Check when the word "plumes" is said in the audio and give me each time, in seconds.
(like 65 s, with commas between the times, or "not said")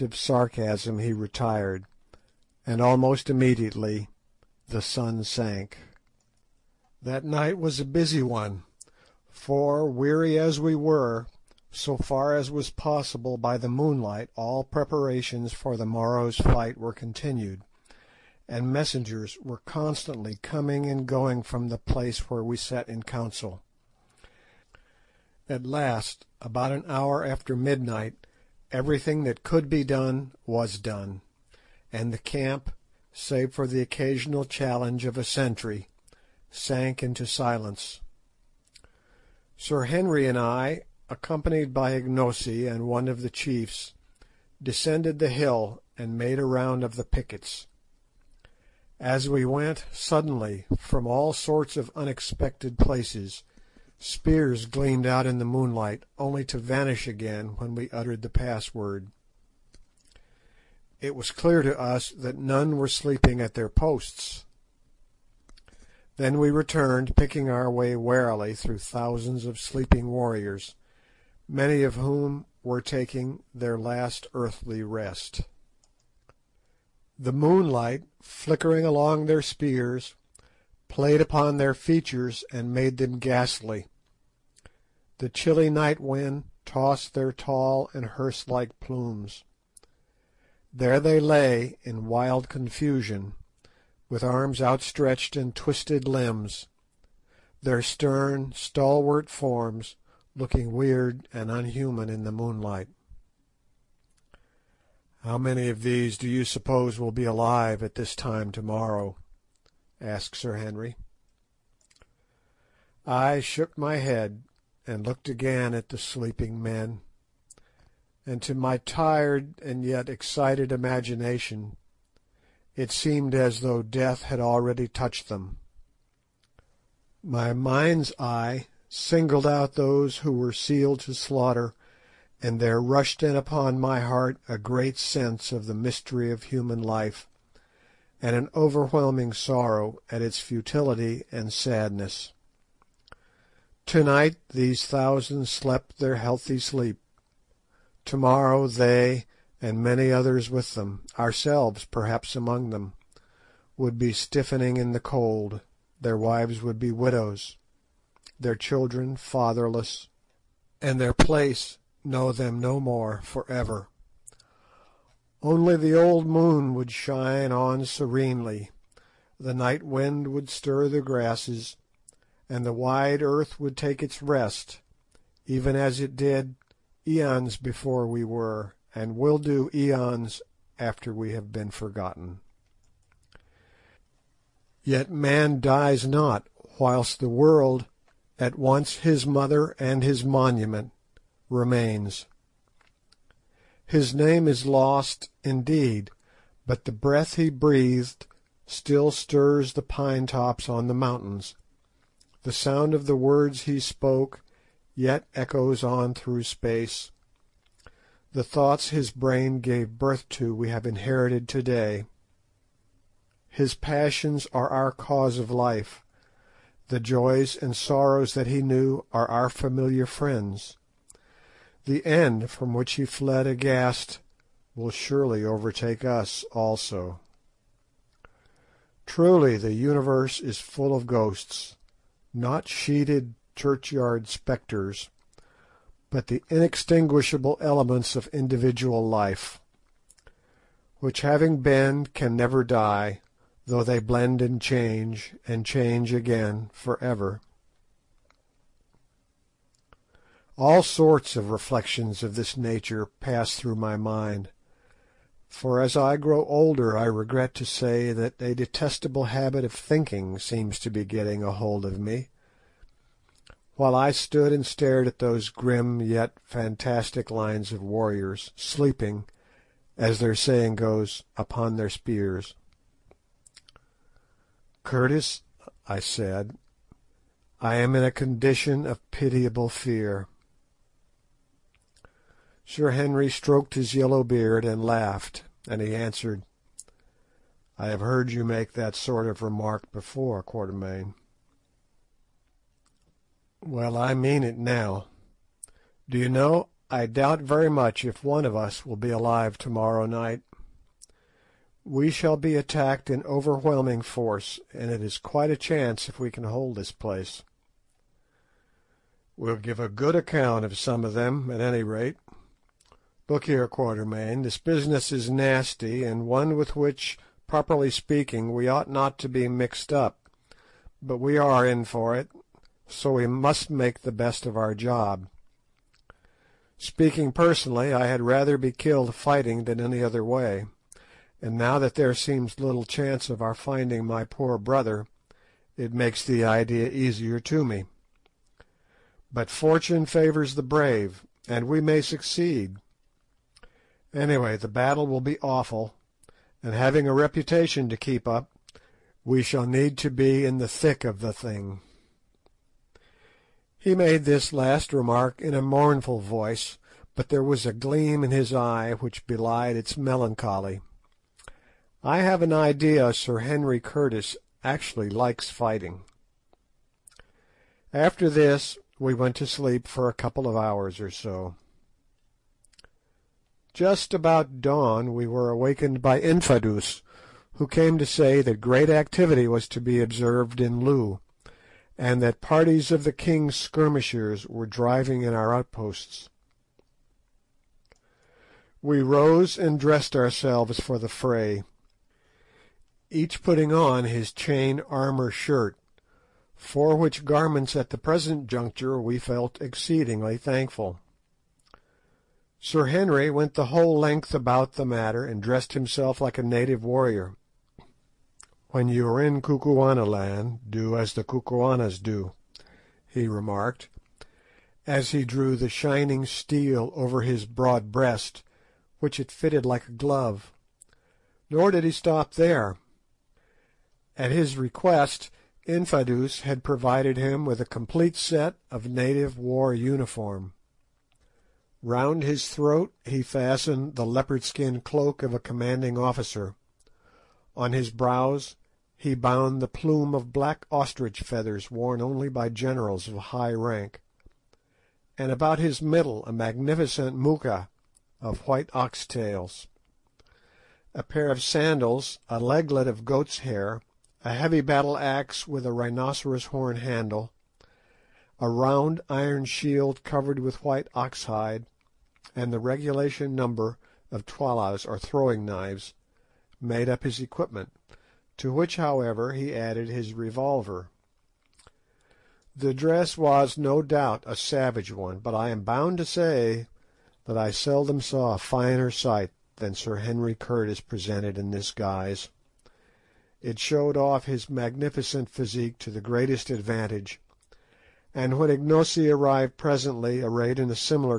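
88 s, 439 s.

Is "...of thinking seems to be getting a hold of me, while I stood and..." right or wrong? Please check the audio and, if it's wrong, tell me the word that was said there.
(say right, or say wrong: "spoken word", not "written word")
right.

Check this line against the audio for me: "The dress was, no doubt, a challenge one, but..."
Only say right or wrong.
wrong.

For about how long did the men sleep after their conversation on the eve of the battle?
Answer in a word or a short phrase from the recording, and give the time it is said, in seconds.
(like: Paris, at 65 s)
a couple of hours, at 370 s.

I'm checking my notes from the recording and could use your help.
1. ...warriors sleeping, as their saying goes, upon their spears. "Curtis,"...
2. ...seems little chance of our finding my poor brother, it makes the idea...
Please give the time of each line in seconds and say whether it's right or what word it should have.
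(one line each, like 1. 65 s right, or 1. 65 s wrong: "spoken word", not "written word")
1. 267 s right
2. 332 s right.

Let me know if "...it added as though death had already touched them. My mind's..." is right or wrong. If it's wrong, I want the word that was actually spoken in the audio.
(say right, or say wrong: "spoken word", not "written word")
wrong: "seemed", not "added".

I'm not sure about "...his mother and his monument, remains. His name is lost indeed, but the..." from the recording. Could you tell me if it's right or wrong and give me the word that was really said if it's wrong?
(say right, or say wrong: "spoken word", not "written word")
right.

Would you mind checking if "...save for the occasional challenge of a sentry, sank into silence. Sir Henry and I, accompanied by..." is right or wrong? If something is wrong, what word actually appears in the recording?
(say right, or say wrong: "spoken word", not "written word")
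right.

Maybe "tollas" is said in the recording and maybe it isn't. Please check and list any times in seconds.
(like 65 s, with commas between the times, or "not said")
464 s.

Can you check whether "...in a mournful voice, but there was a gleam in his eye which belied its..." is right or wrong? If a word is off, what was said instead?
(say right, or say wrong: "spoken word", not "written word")
right.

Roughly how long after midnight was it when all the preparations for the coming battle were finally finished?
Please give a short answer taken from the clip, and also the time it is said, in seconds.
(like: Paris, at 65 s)
about an hour, at 26 s.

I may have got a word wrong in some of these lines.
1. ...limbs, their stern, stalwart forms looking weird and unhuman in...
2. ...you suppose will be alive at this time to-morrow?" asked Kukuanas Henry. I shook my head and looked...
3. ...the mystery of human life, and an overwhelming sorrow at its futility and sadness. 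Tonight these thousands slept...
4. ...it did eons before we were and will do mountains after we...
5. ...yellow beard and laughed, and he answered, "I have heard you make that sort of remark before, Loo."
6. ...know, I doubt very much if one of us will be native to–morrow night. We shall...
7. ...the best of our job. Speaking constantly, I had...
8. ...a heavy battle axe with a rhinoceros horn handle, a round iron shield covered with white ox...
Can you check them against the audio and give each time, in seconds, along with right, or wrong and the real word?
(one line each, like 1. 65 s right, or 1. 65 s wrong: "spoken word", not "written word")
1. 96 s right
2. 106 s wrong: "Sir", not "Kukuanas"
3. 135 s right
4. 175 s wrong: "aeons", not "mountains"
5. 283 s wrong: "Quatermain", not "Loo"
6. 296 s wrong: "alive", not "native"
7. 324 s wrong: "personally", not "constantly"
8. 454 s right.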